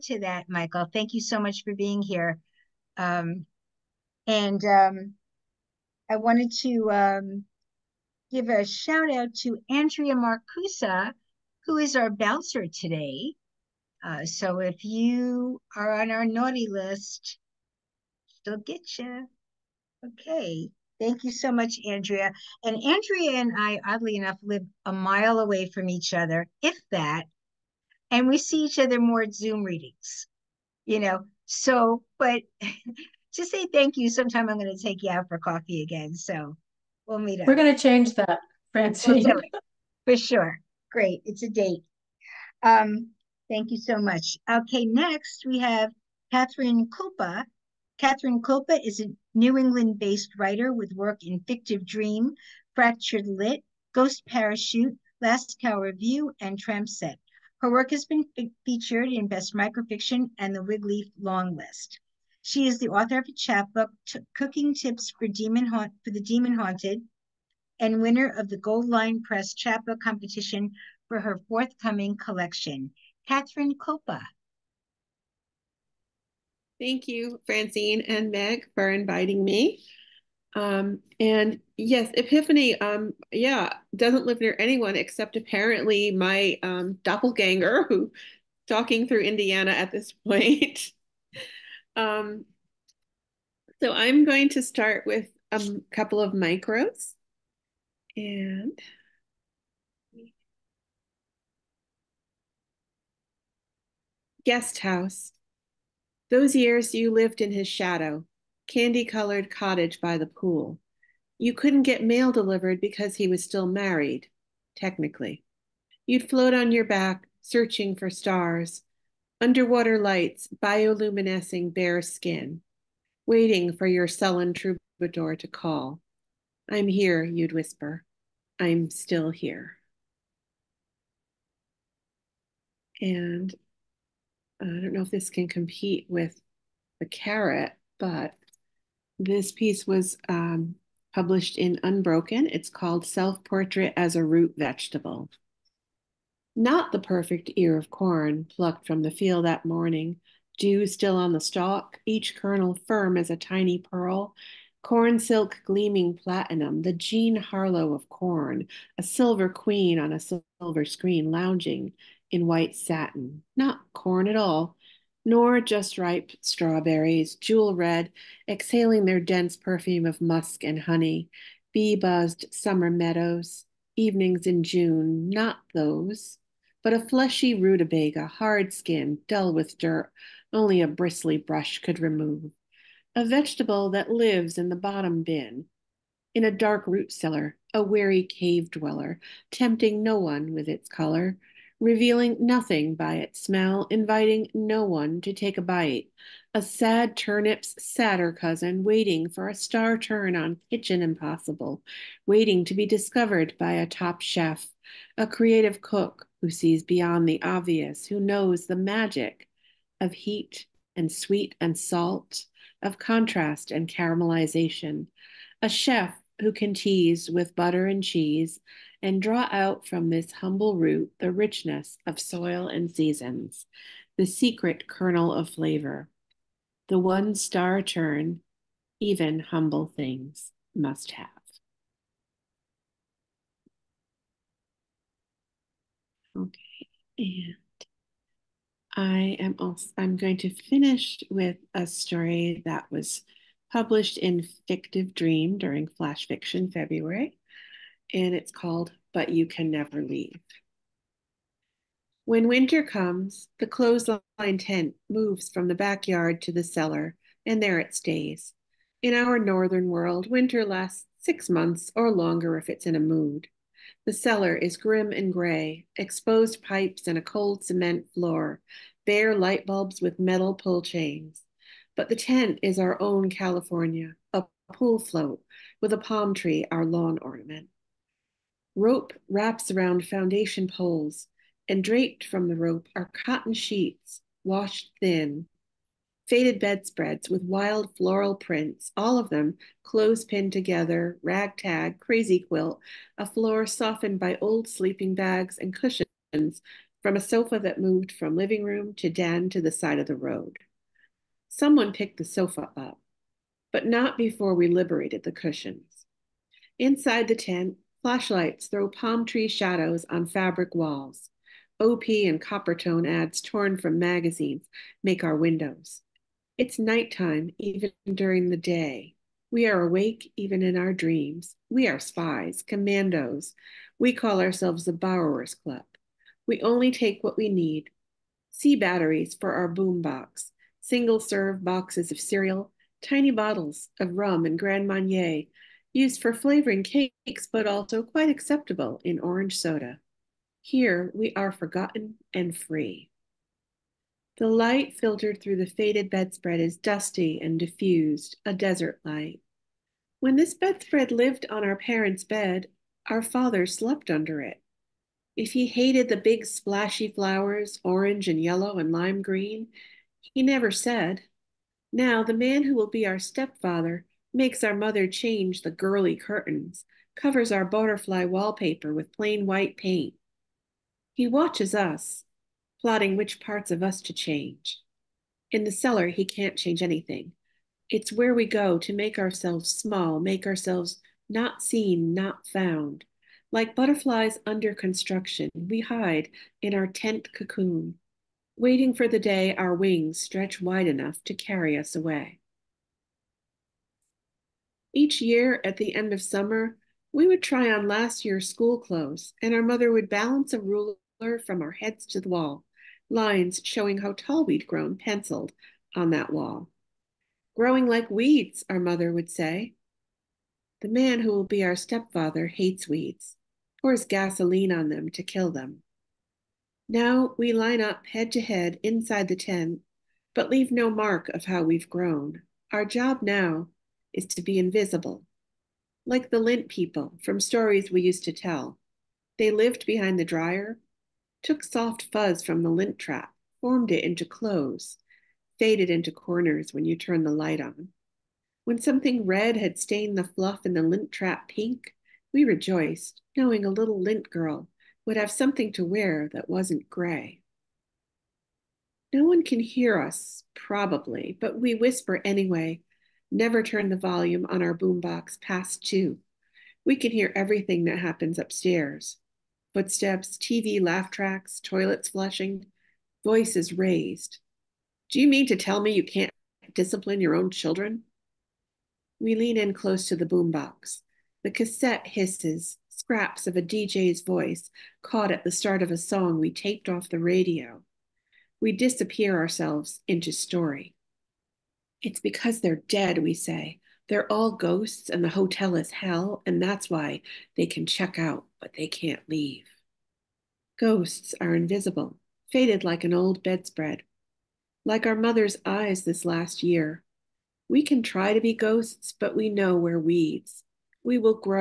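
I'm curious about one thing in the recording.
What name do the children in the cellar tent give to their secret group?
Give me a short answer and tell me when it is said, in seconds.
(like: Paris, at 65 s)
the Borrowers Club, at 324 s.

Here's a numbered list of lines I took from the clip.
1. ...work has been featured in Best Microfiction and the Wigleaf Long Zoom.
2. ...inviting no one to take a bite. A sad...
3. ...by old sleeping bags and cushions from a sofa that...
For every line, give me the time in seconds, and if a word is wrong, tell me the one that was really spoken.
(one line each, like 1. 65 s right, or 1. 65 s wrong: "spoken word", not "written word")
1. 57 s wrong: "List", not "Zoom"
2. 193 s right
3. 294 s right.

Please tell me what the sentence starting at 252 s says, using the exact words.
When winter comes, the clothesline tent moves from the backyard to the cellar, and there it stays.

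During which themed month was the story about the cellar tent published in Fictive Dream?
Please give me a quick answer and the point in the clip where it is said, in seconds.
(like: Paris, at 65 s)
Flash Fiction February, at 245 s.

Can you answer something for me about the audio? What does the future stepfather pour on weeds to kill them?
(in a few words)
gasoline.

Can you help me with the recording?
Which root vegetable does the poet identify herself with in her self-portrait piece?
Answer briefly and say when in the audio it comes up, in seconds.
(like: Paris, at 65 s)
rutabaga, at 177 s.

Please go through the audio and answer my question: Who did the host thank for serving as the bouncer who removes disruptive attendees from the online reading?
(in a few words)
Andrea Marcusa.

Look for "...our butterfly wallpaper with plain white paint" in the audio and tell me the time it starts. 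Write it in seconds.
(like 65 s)
367 s.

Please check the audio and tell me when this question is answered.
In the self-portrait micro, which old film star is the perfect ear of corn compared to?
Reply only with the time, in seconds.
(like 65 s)
156 s.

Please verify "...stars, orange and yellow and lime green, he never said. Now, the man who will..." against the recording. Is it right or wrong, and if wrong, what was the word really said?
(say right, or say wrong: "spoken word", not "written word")
wrong: "flowers", not "stars".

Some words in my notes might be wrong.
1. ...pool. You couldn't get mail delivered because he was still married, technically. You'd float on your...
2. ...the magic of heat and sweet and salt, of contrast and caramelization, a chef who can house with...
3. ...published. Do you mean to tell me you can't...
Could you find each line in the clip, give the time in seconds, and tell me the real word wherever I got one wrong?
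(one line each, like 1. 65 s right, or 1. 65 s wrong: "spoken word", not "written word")
1. 110 s right
2. 208 s wrong: "tease", not "house"
3. 463 s wrong: "raised", not "published".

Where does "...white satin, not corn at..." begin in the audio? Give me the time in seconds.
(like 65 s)
162 s.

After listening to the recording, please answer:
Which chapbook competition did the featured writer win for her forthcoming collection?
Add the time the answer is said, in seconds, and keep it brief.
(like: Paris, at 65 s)
Gold Line Press, at 68 s.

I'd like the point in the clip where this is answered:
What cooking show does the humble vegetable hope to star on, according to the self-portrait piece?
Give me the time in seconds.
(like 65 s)
200 s.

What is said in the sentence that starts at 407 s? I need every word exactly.
Growing like weeds, our mother would say.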